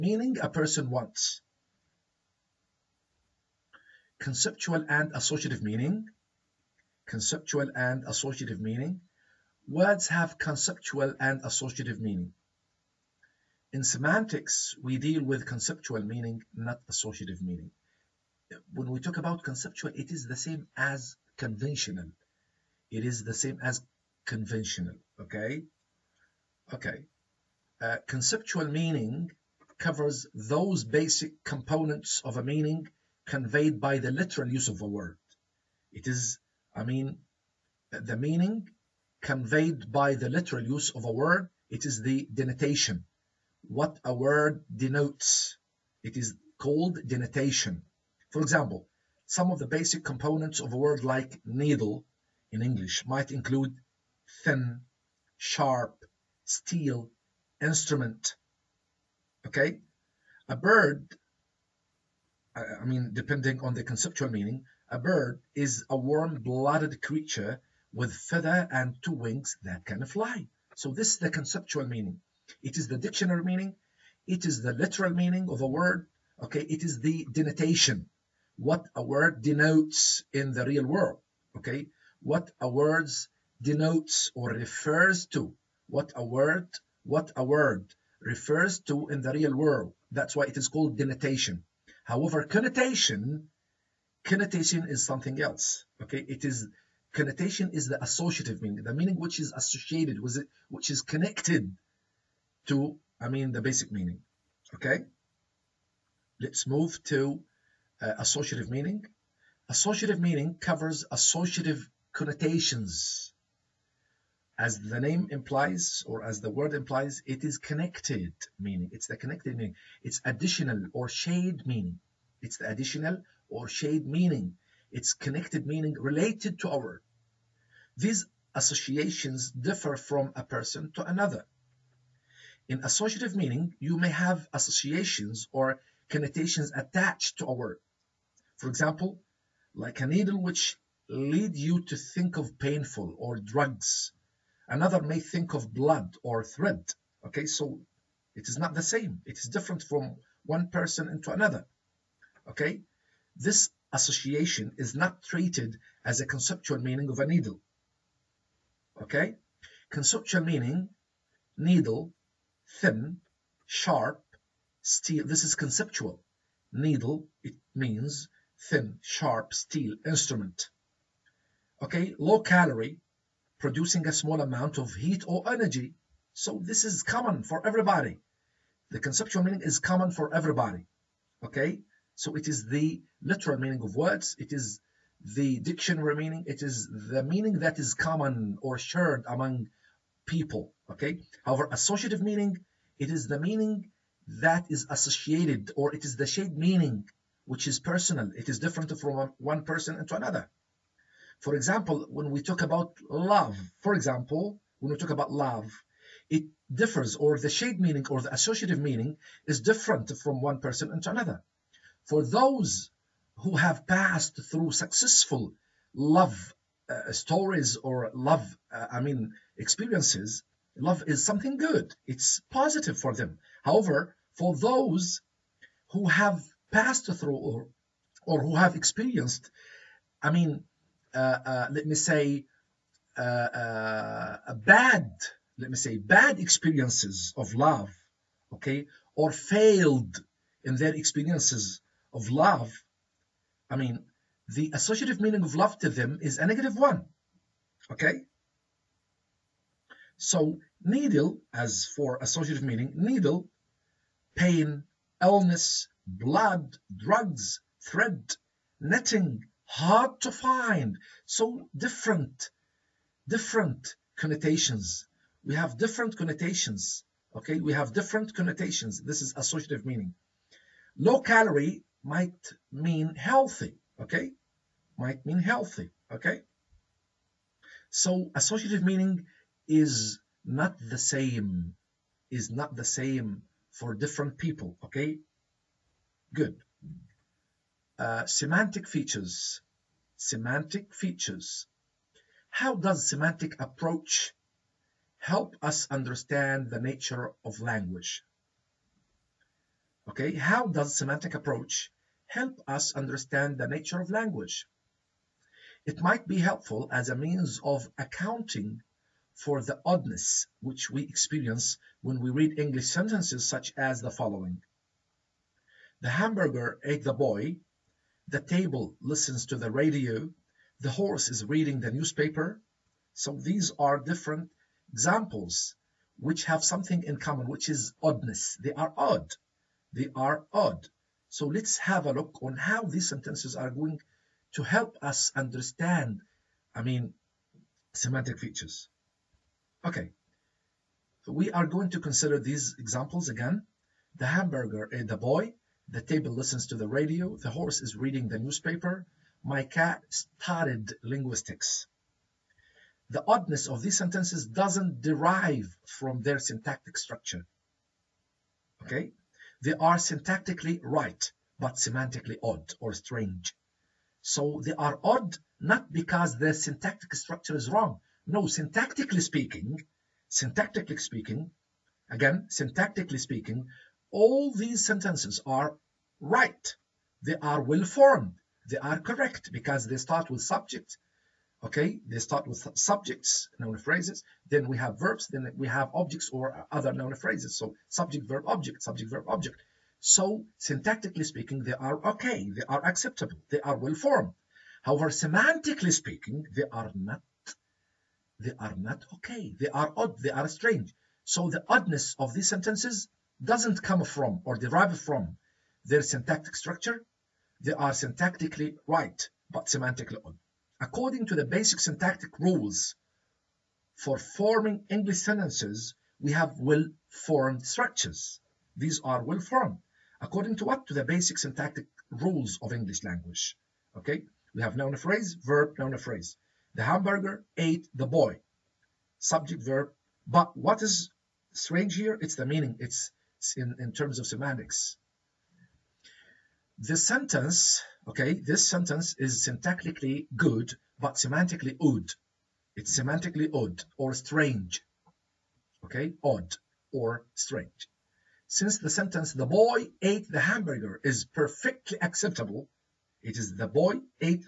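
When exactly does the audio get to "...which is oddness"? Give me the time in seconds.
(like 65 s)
327 s.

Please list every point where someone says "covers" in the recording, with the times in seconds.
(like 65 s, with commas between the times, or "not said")
29 s, 110 s.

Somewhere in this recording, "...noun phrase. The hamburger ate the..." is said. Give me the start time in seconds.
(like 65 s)
425 s.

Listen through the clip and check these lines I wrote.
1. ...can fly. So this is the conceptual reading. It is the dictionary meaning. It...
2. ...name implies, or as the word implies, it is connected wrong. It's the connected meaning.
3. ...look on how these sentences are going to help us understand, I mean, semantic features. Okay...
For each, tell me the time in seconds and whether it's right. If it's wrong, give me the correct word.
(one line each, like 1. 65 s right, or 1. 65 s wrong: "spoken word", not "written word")
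1. 69 s wrong: "meaning", not "reading"
2. 114 s wrong: "meaning", not "wrong"
3. 332 s right.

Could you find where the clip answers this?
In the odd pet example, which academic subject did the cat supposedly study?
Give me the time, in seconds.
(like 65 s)
349 s.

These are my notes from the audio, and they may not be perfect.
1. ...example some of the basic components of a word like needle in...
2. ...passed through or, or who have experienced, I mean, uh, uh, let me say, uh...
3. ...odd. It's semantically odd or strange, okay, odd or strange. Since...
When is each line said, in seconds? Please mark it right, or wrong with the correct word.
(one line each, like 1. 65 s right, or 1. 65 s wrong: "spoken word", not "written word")
1. 48 s right
2. 226 s right
3. 441 s right.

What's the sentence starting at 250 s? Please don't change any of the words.
So needle, as for associative meaning, needle, pain, illness, blood, drugs, thread, netting, hard to find, so different, different connotations.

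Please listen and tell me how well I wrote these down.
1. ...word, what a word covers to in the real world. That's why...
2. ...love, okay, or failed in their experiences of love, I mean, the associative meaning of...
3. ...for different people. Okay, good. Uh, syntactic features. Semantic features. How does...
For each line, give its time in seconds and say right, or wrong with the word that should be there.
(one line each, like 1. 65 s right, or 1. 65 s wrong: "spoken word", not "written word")
1. 86 s wrong: "refers", not "covers"
2. 237 s right
3. 283 s wrong: "semantic", not "syntactic".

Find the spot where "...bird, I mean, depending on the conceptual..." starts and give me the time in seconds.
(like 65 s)
60 s.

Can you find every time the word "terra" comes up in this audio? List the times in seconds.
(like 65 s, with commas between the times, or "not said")
not said.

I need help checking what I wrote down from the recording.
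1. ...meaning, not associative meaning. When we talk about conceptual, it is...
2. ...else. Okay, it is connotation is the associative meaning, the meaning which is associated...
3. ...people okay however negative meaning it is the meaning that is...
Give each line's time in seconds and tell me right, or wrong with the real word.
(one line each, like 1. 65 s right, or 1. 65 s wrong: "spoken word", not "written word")
1. 16 s right
2. 95 s right
3. 190 s wrong: "associative", not "negative".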